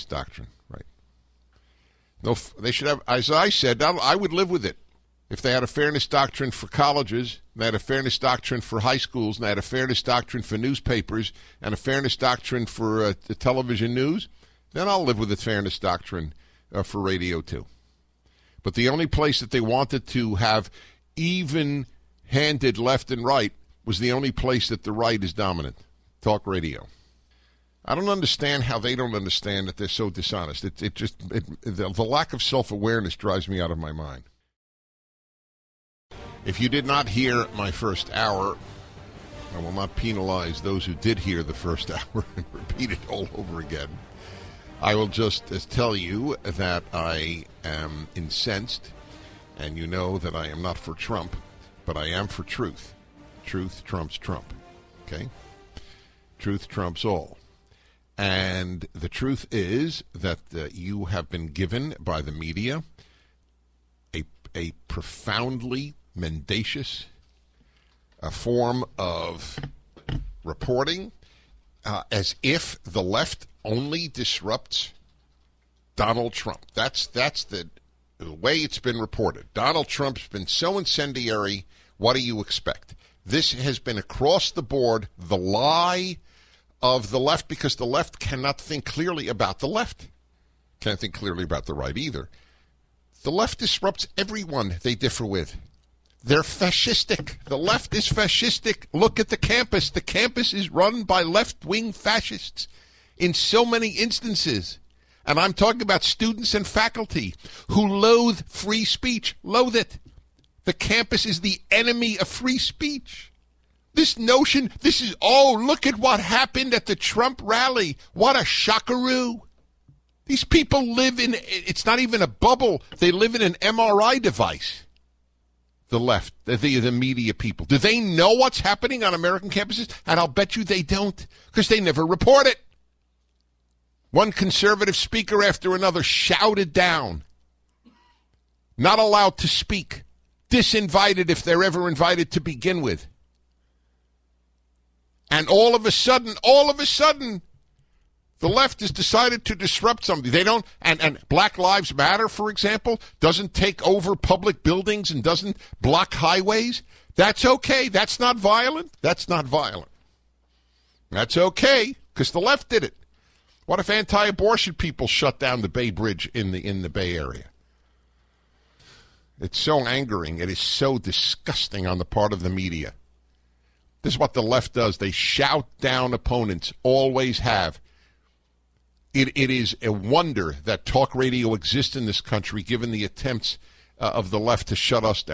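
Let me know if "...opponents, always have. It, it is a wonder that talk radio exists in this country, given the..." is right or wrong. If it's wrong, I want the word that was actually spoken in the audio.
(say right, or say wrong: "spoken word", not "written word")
right.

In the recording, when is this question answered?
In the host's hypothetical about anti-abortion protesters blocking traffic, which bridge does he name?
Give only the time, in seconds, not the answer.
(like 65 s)
165 s.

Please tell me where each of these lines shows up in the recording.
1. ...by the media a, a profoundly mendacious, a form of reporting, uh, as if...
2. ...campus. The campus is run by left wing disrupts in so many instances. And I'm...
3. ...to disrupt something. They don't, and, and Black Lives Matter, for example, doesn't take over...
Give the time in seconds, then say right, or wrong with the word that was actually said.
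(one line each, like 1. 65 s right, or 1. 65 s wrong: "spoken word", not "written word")
1. 61 s right
2. 99 s wrong: "fascists", not "disrupts"
3. 149 s right.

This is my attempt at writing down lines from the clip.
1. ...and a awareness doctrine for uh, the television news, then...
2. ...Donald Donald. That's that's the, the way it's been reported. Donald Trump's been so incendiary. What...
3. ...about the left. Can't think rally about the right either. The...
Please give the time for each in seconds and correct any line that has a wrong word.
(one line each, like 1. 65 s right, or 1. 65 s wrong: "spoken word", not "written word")
1. 11 s wrong: "fairness", not "awareness"
2. 75 s wrong: "Trump", not "Donald"
3. 89 s wrong: "clearly", not "rally".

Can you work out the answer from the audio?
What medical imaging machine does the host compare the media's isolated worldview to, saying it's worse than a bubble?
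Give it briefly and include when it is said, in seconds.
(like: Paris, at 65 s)
MRI device, at 123 s.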